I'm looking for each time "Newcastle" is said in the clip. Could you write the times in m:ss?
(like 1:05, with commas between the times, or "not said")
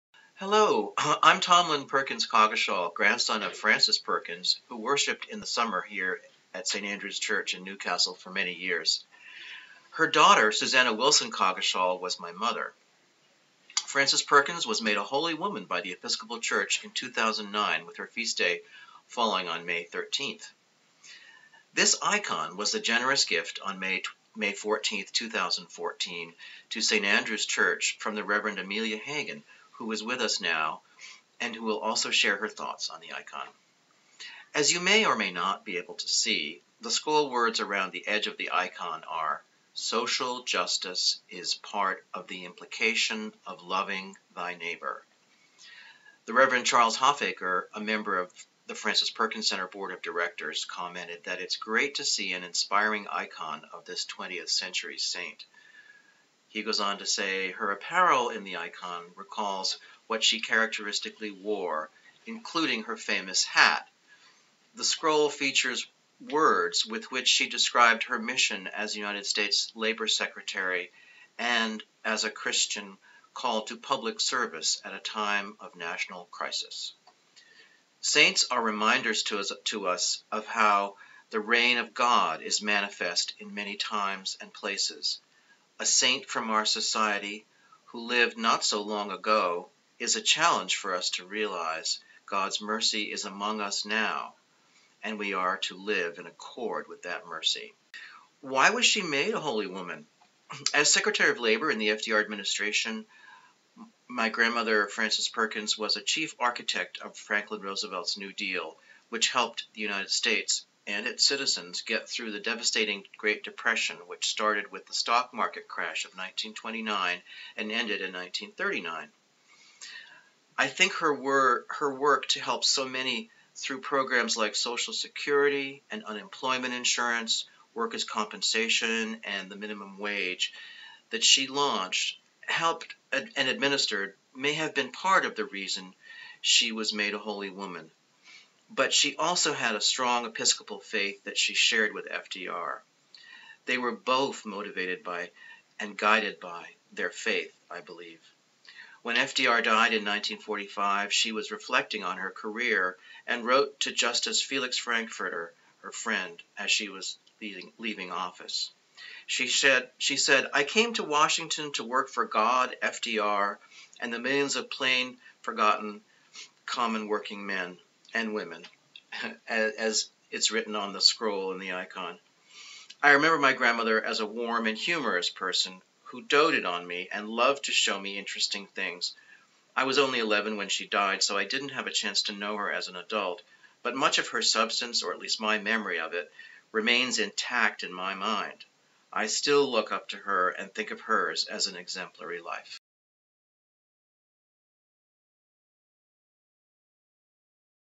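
0:07.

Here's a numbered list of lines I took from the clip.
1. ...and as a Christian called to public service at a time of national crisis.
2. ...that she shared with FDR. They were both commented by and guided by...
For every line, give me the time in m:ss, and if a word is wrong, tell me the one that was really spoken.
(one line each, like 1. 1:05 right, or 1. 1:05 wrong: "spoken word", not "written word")
1. 1:11 right
2. 2:21 wrong: "motivated", not "commented".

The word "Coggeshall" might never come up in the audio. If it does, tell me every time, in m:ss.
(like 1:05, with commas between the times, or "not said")
0:02, 0:11.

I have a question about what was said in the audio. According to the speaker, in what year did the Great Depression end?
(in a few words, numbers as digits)
1939.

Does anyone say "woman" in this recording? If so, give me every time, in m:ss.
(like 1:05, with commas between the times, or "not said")
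0:15, 1:39, 2:17.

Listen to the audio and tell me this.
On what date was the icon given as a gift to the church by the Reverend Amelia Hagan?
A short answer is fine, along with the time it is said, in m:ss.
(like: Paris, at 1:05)
May 14th, 2014, at 0:24.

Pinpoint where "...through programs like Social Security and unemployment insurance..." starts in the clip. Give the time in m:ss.
2:03.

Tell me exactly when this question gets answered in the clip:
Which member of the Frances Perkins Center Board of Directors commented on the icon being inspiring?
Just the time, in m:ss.
0:46.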